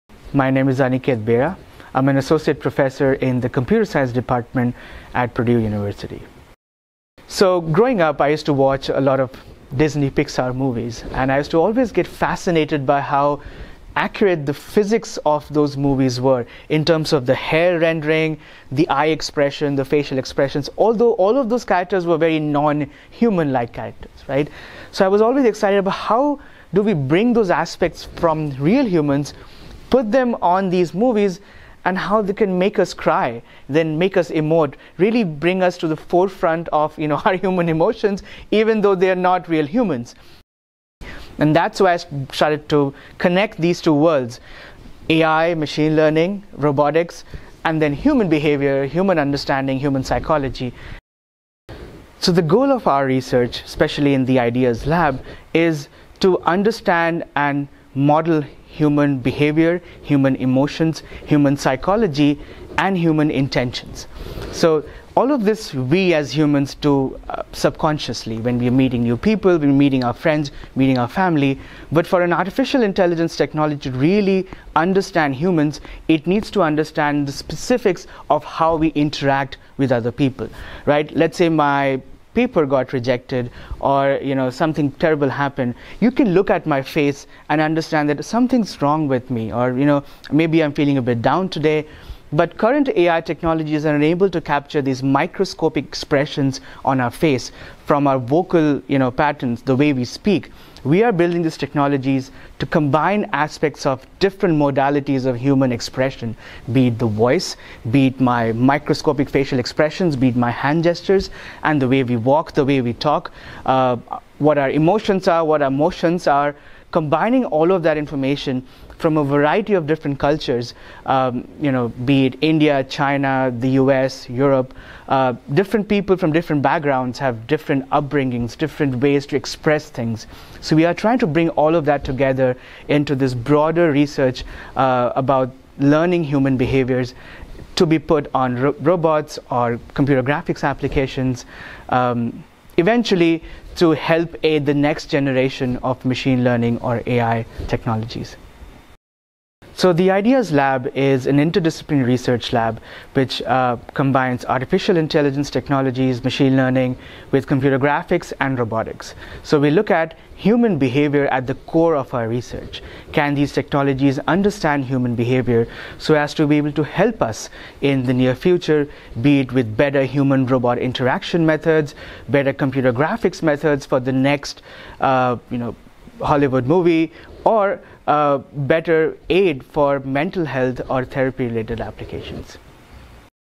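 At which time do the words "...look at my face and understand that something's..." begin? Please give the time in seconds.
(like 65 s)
86 s.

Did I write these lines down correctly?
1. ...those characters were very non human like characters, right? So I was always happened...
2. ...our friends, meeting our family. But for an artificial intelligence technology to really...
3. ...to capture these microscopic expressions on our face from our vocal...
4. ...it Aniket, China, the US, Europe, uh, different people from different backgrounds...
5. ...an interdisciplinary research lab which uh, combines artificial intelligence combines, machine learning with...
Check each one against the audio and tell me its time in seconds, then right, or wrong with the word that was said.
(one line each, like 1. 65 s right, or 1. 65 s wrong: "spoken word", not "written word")
1. 21 s wrong: "excited", not "happened"
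2. 70 s right
3. 94 s right
4. 122 s wrong: "India", not "Aniket"
5. 151 s wrong: "technologies", not "combines".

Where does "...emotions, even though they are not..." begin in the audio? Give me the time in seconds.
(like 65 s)
37 s.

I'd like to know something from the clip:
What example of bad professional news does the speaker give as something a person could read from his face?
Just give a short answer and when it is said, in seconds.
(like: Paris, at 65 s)
paper got rejected, at 82 s.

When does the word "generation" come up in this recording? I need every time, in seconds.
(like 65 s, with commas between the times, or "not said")
145 s.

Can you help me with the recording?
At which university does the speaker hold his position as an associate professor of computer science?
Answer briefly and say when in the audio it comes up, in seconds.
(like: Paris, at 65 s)
Purdue University, at 5 s.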